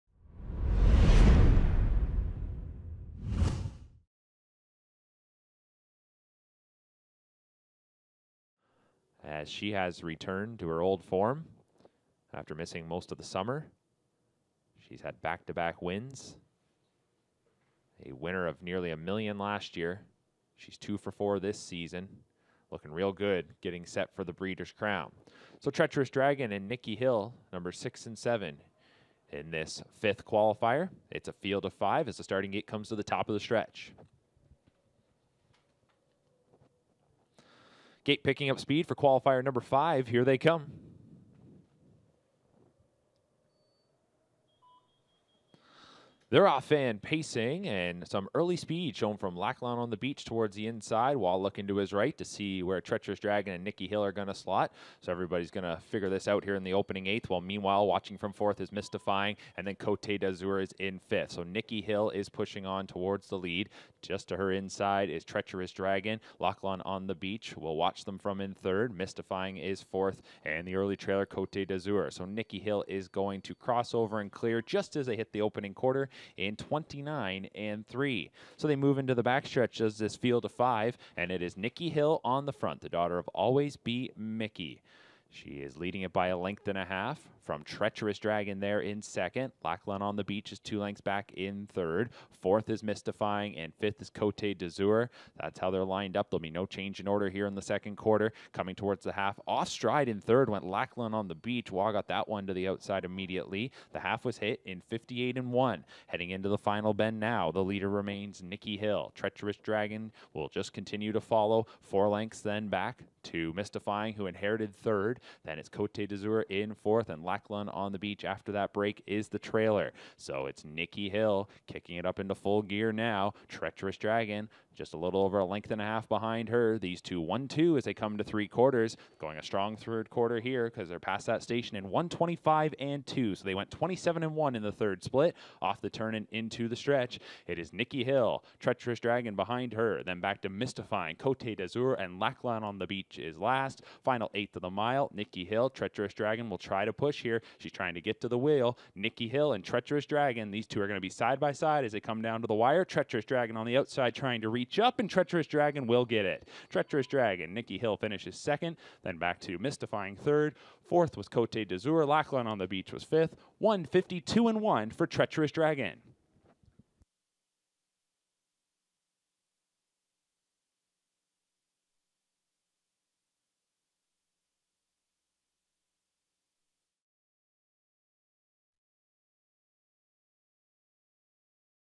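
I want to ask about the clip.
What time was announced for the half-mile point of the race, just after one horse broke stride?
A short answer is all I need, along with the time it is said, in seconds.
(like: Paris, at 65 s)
58.1, at 104 s.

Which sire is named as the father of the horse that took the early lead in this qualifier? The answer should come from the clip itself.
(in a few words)
Always B Miki.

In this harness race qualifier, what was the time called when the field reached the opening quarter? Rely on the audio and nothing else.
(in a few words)
29.3.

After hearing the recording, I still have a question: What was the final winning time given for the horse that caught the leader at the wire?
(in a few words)
1:52.1.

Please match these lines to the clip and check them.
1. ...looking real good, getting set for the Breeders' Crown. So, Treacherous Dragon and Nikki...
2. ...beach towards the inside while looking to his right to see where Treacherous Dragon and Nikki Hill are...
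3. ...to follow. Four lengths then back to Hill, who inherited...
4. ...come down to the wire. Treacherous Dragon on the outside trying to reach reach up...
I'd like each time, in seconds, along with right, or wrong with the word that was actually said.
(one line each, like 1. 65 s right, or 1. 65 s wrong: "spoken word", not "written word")
1. 22 s right
2. 49 s right
3. 111 s wrong: "Mystifying", not "Hill"
4. 151 s right.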